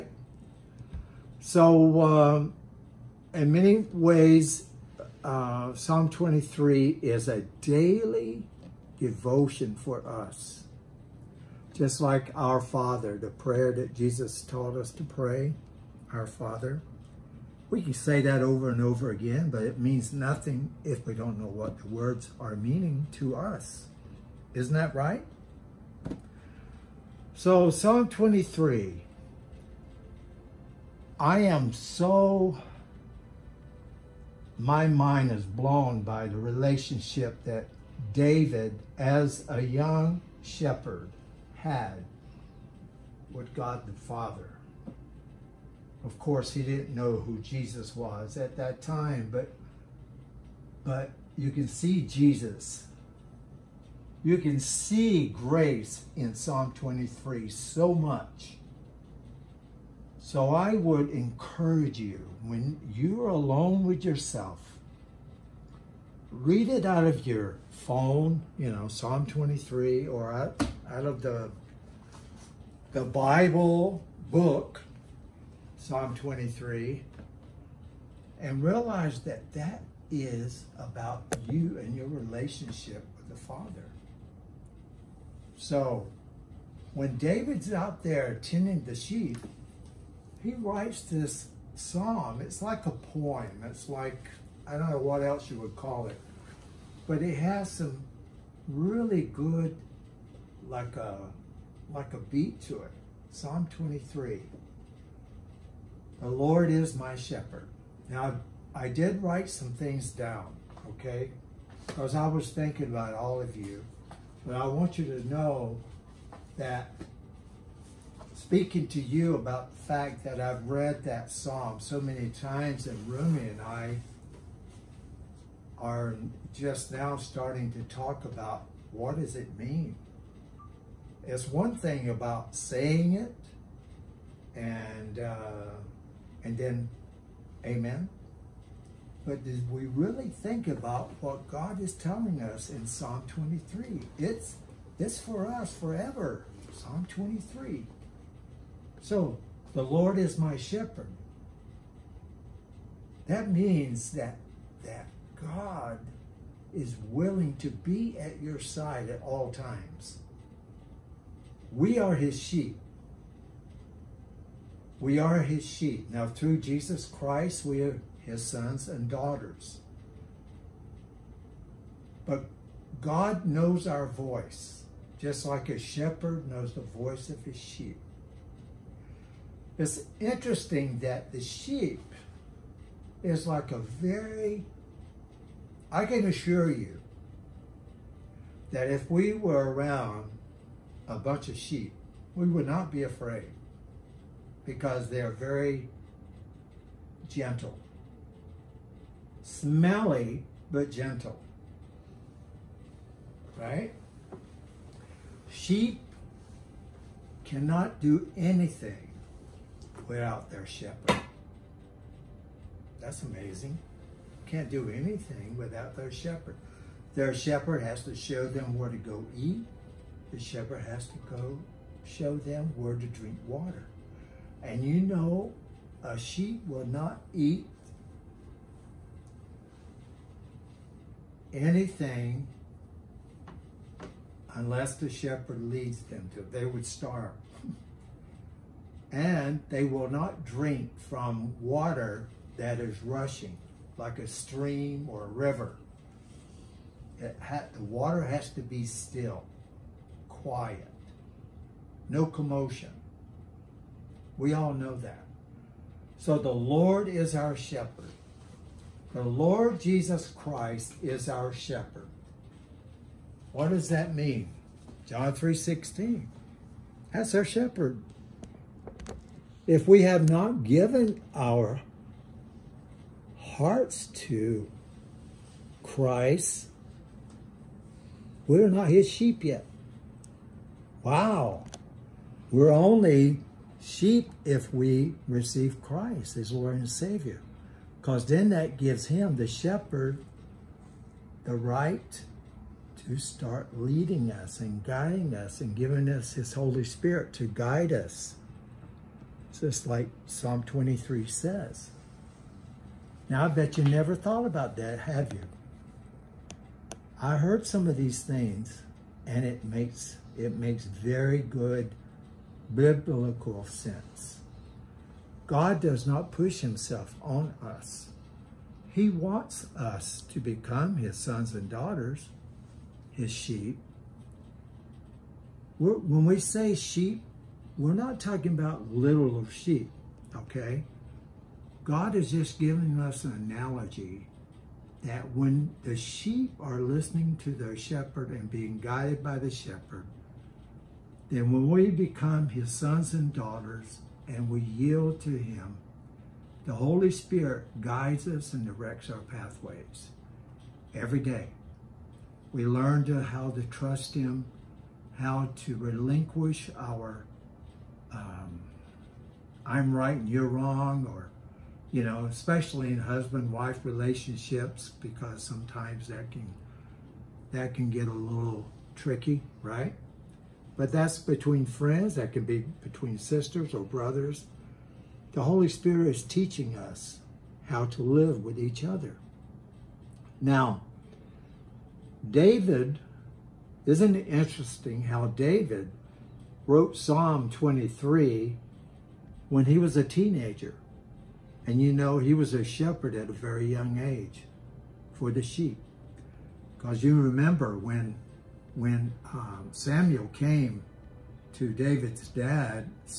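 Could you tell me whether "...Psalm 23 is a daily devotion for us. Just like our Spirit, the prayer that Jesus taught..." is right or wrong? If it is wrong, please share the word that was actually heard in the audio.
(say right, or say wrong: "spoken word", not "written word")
wrong: "Father", not "Spirit".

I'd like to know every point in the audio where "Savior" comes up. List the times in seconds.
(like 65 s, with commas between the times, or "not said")
286 s.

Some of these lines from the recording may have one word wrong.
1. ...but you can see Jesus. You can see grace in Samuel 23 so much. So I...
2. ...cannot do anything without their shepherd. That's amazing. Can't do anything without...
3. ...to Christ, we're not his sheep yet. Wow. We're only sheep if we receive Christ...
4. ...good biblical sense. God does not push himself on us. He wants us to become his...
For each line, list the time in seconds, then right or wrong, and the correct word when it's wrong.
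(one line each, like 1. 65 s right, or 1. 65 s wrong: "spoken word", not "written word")
1. 50 s wrong: "Psalm", not "Samuel"
2. 207 s right
3. 274 s right
4. 311 s right.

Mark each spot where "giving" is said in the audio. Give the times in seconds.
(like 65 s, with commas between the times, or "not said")
295 s, 332 s.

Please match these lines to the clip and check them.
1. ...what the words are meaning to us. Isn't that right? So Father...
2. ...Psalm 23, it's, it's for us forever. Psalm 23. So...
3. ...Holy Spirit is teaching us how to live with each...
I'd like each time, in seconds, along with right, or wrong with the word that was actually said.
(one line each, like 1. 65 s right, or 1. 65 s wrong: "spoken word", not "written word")
1. 21 s wrong: "Psalm", not "Father"
2. 142 s right
3. 375 s right.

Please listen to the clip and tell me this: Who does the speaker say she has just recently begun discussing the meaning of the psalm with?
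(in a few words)
Rummy.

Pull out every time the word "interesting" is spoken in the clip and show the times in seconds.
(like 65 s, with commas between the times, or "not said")
180 s, 384 s.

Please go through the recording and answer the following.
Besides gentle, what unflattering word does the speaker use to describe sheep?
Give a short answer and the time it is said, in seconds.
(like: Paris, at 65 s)
Smelly, at 199 s.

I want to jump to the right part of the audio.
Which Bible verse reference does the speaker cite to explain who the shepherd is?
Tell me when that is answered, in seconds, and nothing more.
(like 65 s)
265 s.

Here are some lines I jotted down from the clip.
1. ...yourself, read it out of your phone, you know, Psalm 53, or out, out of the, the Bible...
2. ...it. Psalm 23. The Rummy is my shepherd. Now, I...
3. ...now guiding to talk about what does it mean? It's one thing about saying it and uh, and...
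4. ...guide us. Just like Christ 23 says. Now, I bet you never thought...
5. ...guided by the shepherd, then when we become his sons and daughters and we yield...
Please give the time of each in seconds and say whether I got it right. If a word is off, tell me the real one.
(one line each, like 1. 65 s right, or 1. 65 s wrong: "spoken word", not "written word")
1. 64 s wrong: "23", not "53"
2. 102 s wrong: "Lord", not "Rummy"
3. 126 s wrong: "starting", not "guiding"
4. 297 s wrong: "Psalm", not "Christ"
5. 338 s right.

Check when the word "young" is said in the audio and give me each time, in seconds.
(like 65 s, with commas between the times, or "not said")
39 s, 393 s.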